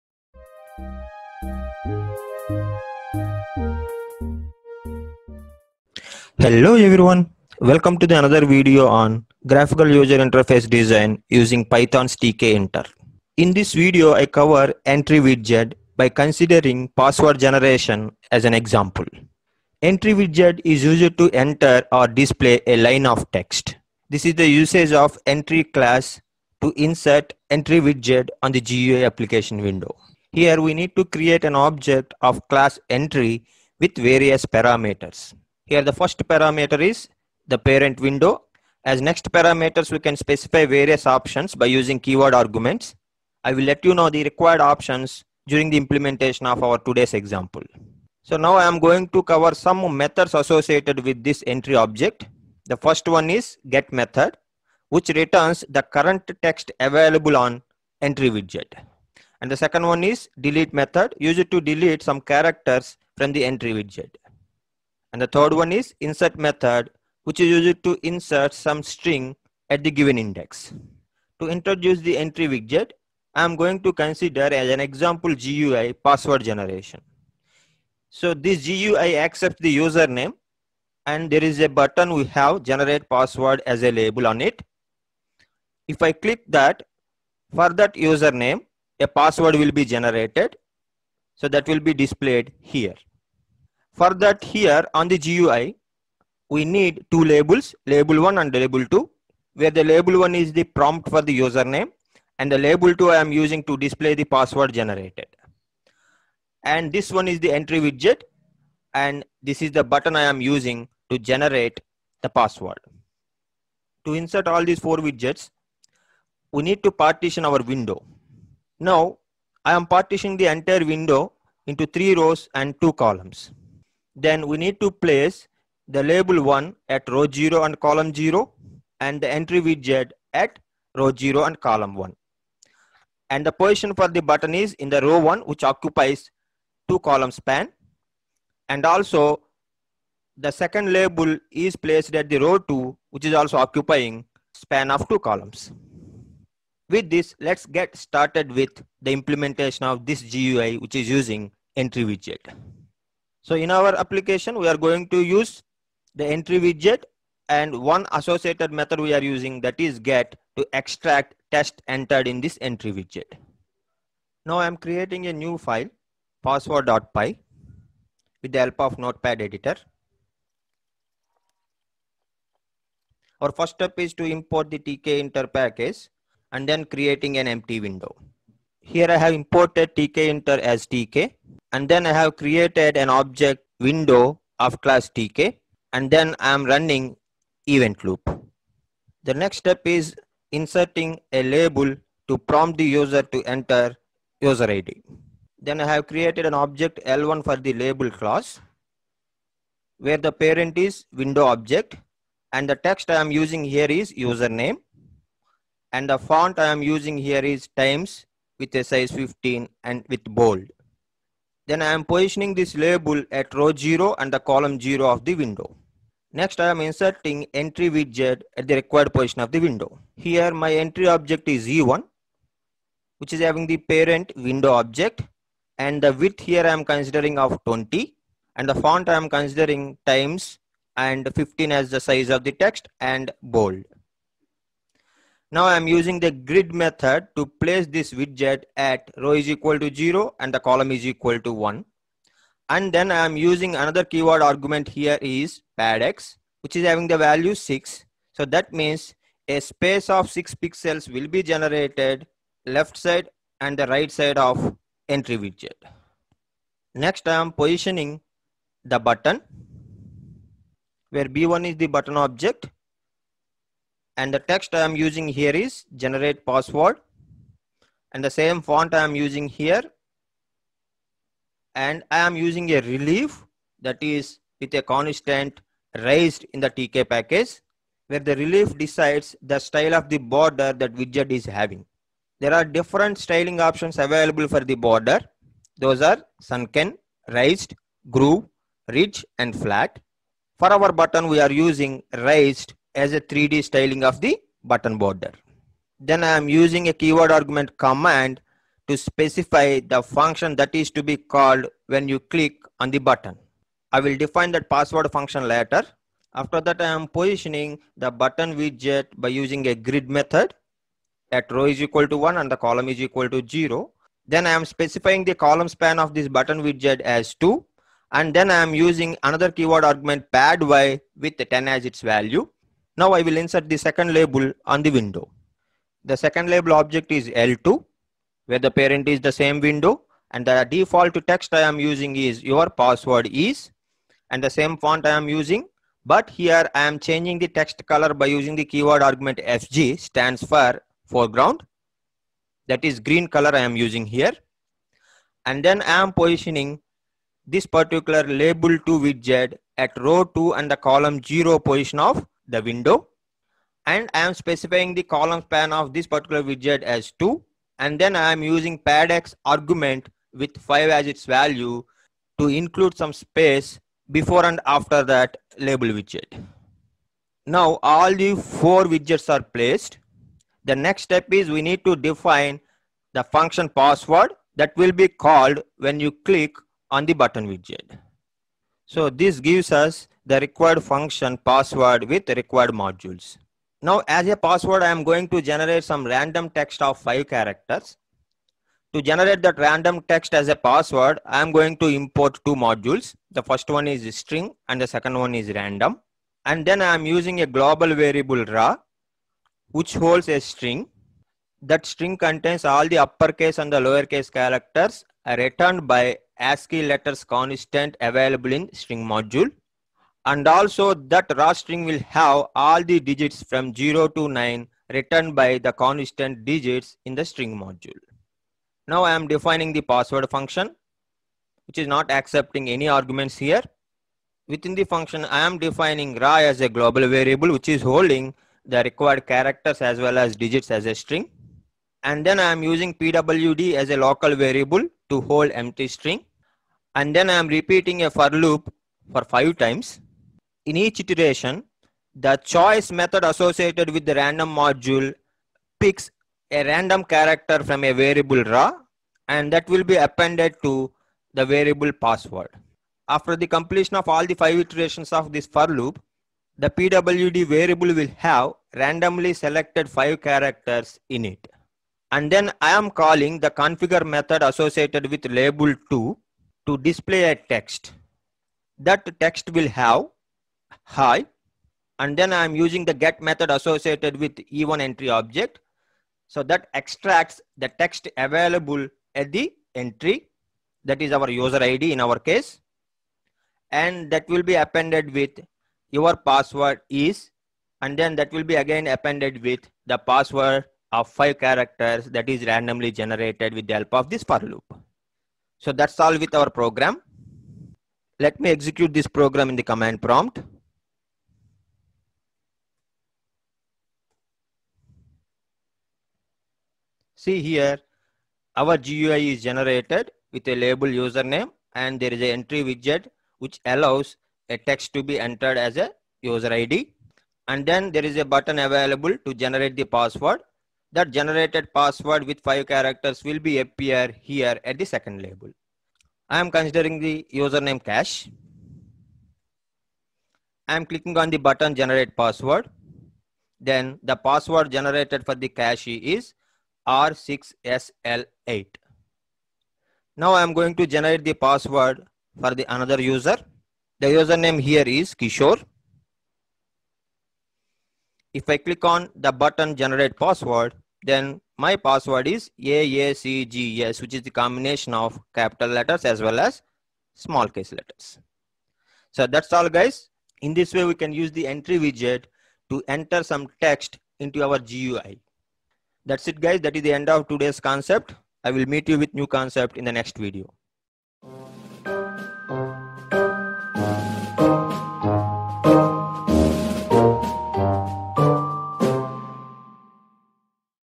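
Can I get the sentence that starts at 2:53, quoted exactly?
Our first step is to import the tkinter package and then creating an empty window.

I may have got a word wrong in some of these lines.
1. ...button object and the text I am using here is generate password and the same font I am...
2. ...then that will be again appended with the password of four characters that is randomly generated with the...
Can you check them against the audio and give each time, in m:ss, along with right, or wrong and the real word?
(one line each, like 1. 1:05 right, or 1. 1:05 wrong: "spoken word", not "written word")
1. 4:21 right
2. 8:07 wrong: "five", not "four".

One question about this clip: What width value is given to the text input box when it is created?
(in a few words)
20.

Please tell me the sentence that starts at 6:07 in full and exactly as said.
Now all the four widgets are placed.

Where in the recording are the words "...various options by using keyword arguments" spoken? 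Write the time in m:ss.
0:40.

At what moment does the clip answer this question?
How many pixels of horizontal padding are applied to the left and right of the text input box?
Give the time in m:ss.
4:10.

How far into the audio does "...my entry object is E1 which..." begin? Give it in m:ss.
3:40.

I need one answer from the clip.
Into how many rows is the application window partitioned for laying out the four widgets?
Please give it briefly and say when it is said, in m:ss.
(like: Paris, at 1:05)
3, at 2:01.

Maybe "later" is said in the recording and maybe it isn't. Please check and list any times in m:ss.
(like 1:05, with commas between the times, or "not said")
5:05.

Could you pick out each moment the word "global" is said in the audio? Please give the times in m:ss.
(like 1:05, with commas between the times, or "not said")
6:37, 7:06.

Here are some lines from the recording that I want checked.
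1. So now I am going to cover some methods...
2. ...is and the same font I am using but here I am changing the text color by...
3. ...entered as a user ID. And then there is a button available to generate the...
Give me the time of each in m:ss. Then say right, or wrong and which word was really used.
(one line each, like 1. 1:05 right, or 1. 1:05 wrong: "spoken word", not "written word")
1. 0:48 right
2. 5:33 right
3. 8:35 right.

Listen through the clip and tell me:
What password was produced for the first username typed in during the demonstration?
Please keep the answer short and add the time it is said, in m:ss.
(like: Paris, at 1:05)
R6SL8, at 8:56.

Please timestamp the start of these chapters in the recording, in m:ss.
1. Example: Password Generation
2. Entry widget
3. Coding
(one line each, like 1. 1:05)
1. 1:10
2. 0:20
3. 2:40.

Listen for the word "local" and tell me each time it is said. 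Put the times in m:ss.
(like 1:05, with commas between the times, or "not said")
7:13.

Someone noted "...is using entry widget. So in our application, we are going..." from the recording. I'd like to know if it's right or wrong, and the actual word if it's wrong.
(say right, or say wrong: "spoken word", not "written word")
right.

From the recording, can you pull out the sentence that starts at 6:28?
To generate that random text as a password, I am going to import two modules.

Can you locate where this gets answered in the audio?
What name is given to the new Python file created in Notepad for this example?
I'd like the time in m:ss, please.
2:46.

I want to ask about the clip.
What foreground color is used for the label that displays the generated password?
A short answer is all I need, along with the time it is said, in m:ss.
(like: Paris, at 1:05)
green, at 5:43.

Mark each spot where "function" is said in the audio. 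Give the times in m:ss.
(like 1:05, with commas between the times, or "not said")
5:00, 5:05, 6:13, 6:20, 7:00, 7:04.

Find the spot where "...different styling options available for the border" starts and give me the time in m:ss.
4:42.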